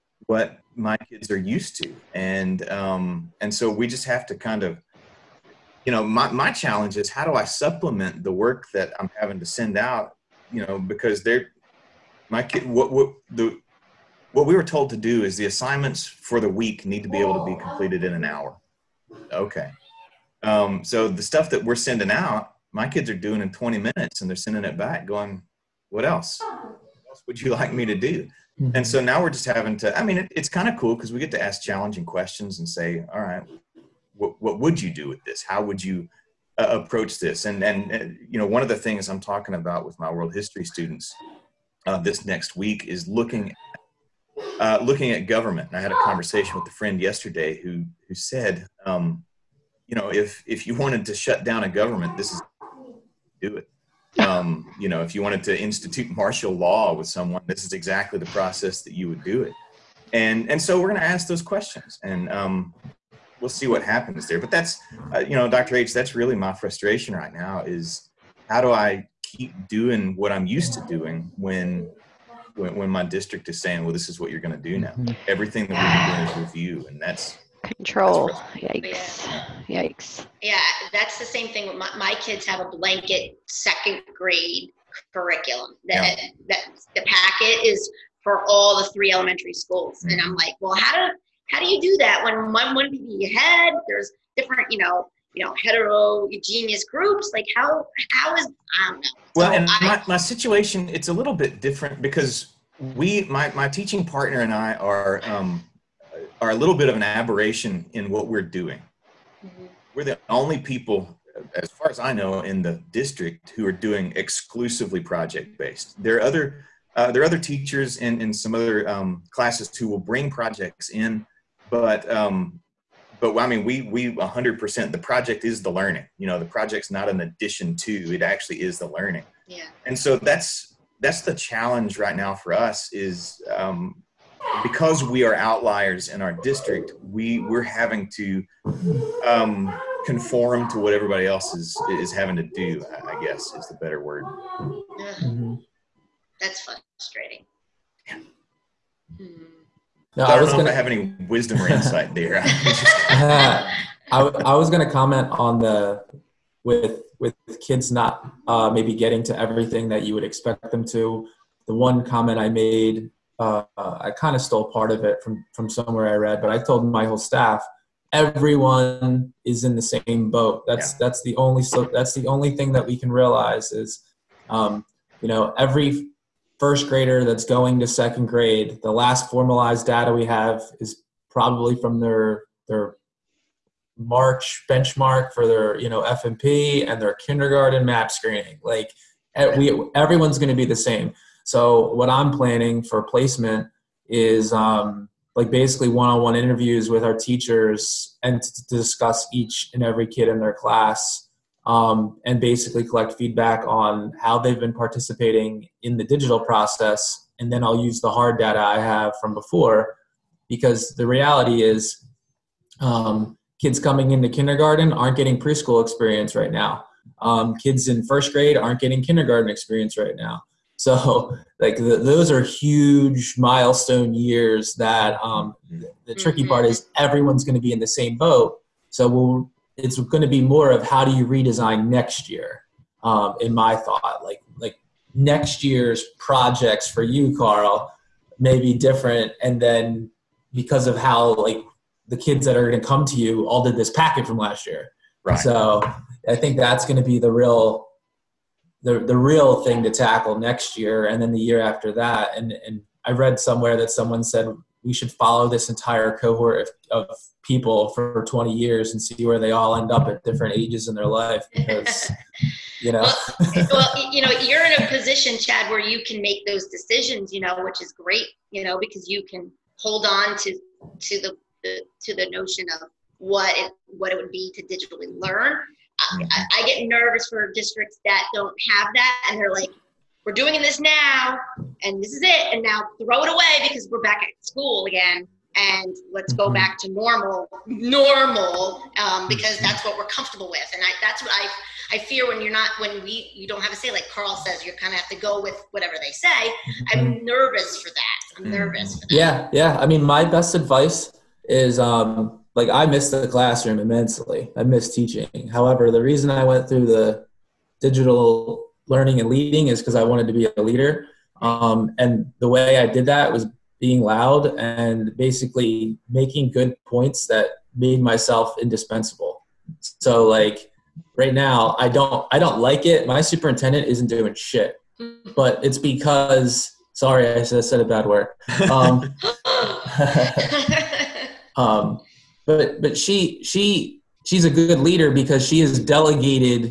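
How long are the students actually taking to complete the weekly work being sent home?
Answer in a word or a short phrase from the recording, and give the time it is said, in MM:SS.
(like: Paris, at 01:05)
20 minutes, at 00:23.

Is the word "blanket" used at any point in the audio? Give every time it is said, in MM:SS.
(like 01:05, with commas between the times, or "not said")
01:22.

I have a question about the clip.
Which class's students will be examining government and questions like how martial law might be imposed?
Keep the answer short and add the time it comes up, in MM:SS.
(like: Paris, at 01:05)
world history, at 00:40.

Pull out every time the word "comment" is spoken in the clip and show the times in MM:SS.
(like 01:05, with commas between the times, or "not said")
02:34, 02:42.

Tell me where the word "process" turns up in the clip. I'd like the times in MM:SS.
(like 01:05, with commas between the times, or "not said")
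00:58, 03:26.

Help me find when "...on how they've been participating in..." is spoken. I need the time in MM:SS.
03:23.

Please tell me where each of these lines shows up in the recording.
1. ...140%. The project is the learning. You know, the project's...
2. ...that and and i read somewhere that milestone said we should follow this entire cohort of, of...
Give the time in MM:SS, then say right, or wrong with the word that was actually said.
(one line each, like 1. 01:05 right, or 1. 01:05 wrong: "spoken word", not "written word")
1. 02:04 wrong: "100", not "140"
2. 04:11 wrong: "someone", not "milestone".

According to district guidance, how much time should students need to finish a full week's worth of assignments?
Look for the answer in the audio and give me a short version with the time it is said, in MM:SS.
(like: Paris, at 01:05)
an hour, at 00:18.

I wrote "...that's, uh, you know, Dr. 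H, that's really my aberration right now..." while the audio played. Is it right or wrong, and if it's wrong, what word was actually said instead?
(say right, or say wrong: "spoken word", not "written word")
wrong: "frustration", not "aberration".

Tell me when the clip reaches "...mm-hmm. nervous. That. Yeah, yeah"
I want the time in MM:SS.
04:58.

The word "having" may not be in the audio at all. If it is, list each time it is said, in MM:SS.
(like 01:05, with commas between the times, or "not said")
00:09, 00:29, 02:17, 02:22.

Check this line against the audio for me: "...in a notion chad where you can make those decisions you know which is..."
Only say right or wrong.
wrong.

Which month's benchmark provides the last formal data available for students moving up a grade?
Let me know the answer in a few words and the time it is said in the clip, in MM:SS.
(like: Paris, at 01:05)
March, at 03:03.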